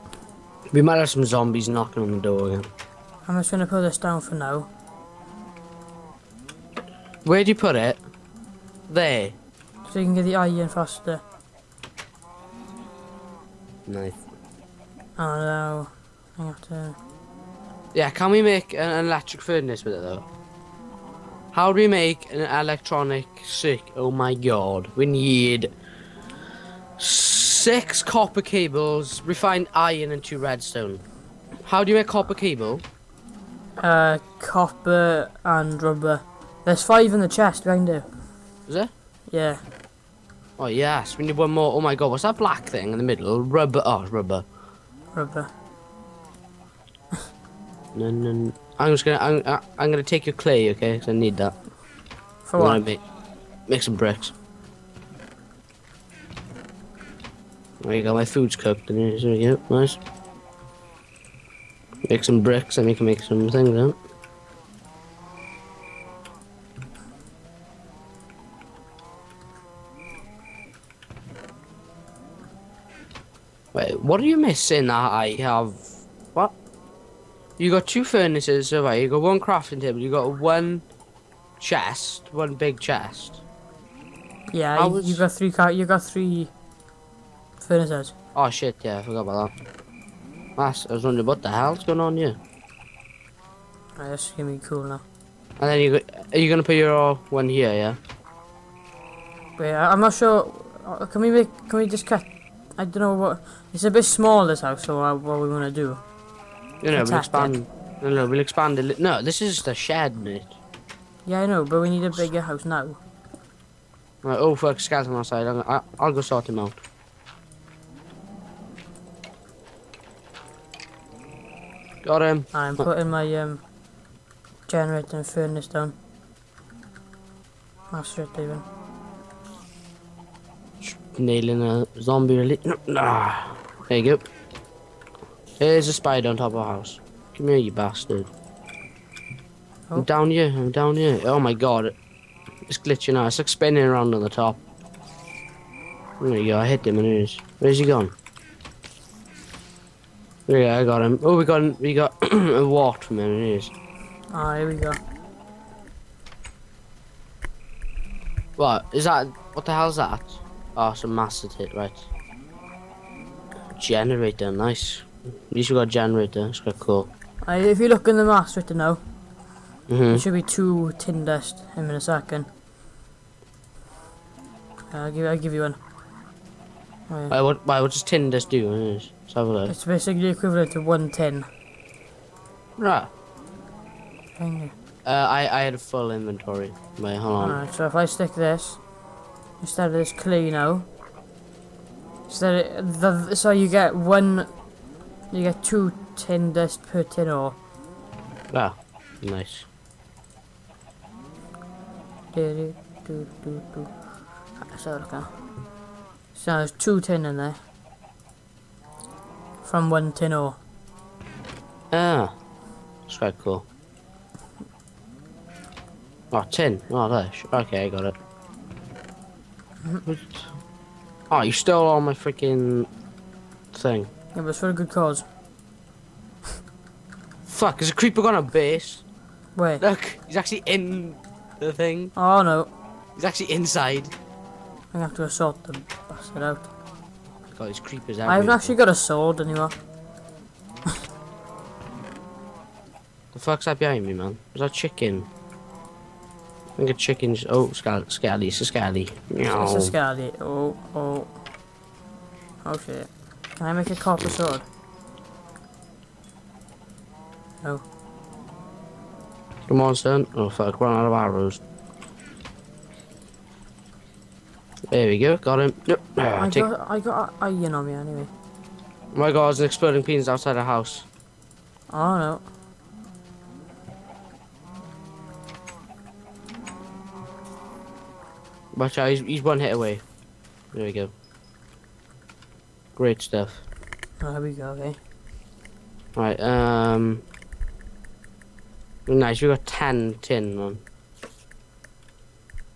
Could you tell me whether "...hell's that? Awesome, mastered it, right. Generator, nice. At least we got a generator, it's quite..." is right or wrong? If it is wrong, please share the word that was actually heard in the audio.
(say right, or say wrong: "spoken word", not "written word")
right.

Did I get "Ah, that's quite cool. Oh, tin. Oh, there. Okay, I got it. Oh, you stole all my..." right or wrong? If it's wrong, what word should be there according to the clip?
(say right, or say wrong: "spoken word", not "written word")
right.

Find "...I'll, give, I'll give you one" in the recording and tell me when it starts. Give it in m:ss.
2:55.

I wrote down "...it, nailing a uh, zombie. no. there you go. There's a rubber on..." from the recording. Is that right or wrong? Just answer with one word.
wrong.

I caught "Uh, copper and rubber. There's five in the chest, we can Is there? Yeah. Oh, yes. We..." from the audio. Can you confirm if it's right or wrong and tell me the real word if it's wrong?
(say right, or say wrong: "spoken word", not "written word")
right.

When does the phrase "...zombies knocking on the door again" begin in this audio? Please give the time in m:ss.
0:01.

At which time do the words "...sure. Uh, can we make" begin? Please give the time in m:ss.
1:40.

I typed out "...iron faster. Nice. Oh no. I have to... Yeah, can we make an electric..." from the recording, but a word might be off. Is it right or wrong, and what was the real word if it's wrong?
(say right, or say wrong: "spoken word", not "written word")
right.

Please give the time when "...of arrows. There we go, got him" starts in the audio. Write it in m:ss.
4:21.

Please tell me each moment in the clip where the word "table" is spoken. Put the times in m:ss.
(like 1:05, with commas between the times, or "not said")
1:19.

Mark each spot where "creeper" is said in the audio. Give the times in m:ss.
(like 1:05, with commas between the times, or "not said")
3:47, 3:57.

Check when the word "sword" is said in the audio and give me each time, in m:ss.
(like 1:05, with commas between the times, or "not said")
3:58, 4:14.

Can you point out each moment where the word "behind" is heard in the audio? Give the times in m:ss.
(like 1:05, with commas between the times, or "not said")
4:03.